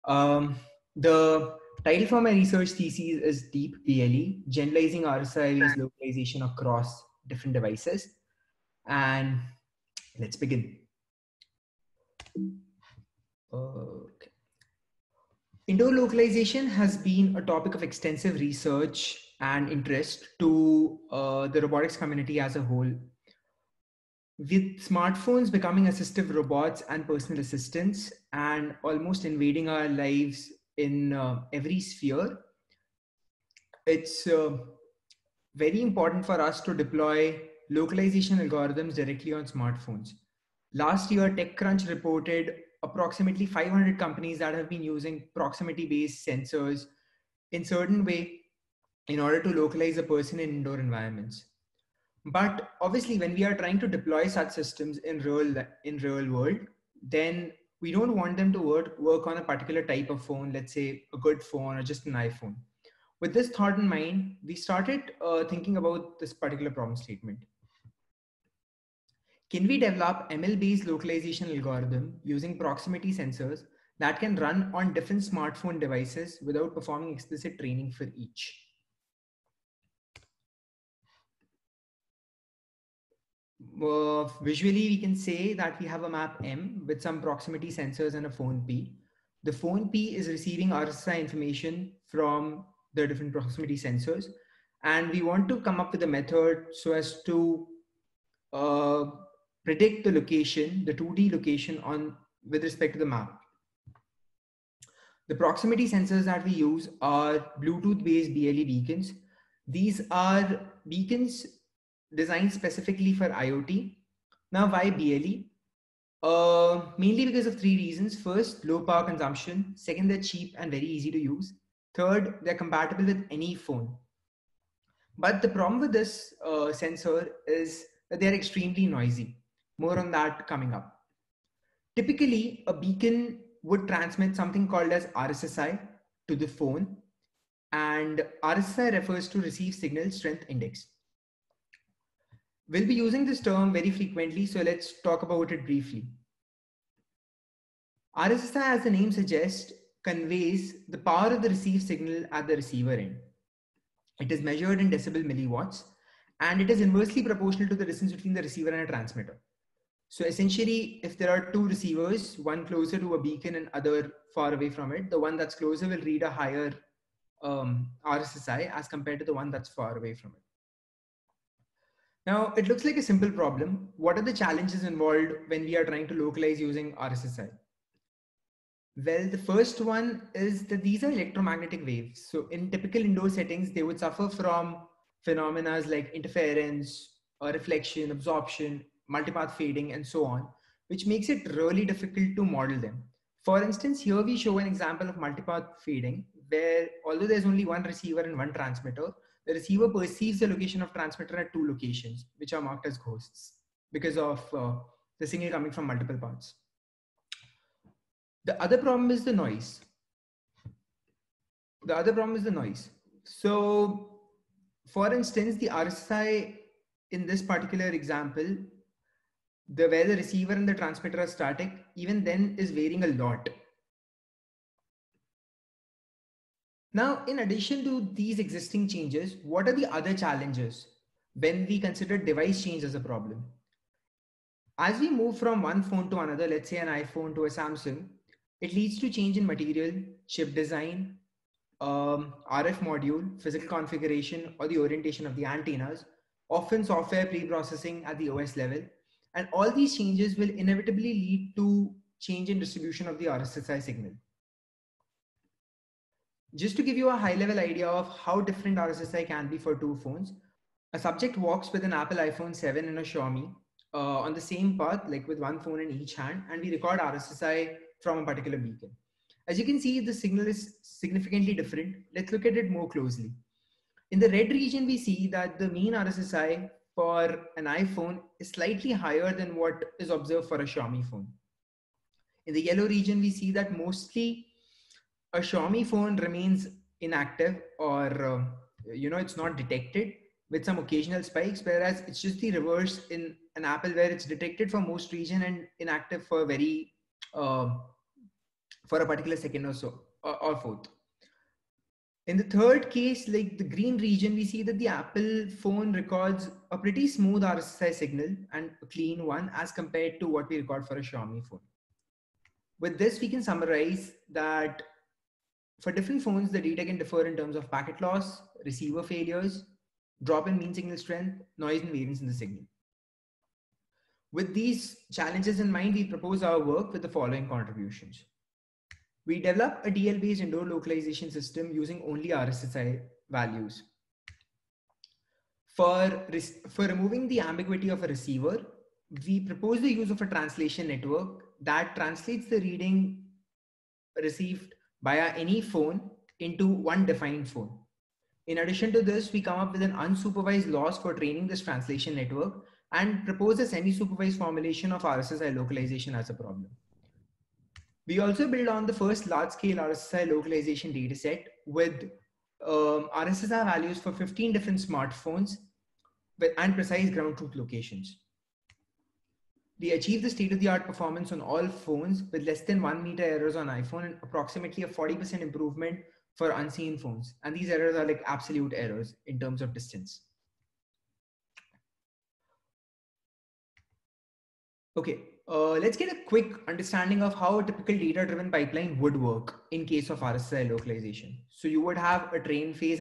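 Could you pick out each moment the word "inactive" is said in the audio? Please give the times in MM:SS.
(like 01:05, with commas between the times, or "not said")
04:46, 04:55.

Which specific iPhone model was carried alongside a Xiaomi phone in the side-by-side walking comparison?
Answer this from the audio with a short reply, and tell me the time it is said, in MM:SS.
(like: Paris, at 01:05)
iPhone 7, at 04:22.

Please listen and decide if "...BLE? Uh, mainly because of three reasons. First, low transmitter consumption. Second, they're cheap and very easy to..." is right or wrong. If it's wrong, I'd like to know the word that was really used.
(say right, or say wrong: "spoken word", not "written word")
wrong: "power", not "transmitter".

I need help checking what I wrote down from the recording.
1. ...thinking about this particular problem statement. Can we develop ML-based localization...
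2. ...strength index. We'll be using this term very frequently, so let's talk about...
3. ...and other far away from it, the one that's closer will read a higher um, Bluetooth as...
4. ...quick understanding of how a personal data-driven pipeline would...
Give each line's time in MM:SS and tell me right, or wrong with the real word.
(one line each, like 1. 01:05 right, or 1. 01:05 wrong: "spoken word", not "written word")
1. 01:05 right
2. 02:20 right
3. 02:43 wrong: "RSSI", not "Bluetooth"
4. 06:26 wrong: "typical", not "personal".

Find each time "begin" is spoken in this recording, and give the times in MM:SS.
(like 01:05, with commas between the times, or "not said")
00:10.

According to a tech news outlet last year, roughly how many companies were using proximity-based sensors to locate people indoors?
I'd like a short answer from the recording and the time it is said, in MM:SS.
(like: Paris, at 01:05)
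500, at 00:42.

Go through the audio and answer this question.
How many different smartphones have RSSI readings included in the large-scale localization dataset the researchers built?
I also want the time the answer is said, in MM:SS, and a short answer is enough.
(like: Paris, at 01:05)
15, at 06:04.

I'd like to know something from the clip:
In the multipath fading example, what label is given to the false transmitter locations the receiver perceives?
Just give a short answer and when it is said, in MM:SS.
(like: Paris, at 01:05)
Ghosts, at 03:22.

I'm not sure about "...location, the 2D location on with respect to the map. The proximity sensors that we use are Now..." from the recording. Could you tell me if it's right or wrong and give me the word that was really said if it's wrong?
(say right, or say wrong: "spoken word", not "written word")
wrong: "Bluetooth", not "Now".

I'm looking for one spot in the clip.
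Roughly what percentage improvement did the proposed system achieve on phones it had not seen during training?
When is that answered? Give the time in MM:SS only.
06:14.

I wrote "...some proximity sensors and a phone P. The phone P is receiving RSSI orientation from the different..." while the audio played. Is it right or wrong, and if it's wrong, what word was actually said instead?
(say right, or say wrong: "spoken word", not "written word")
wrong: "information", not "orientation".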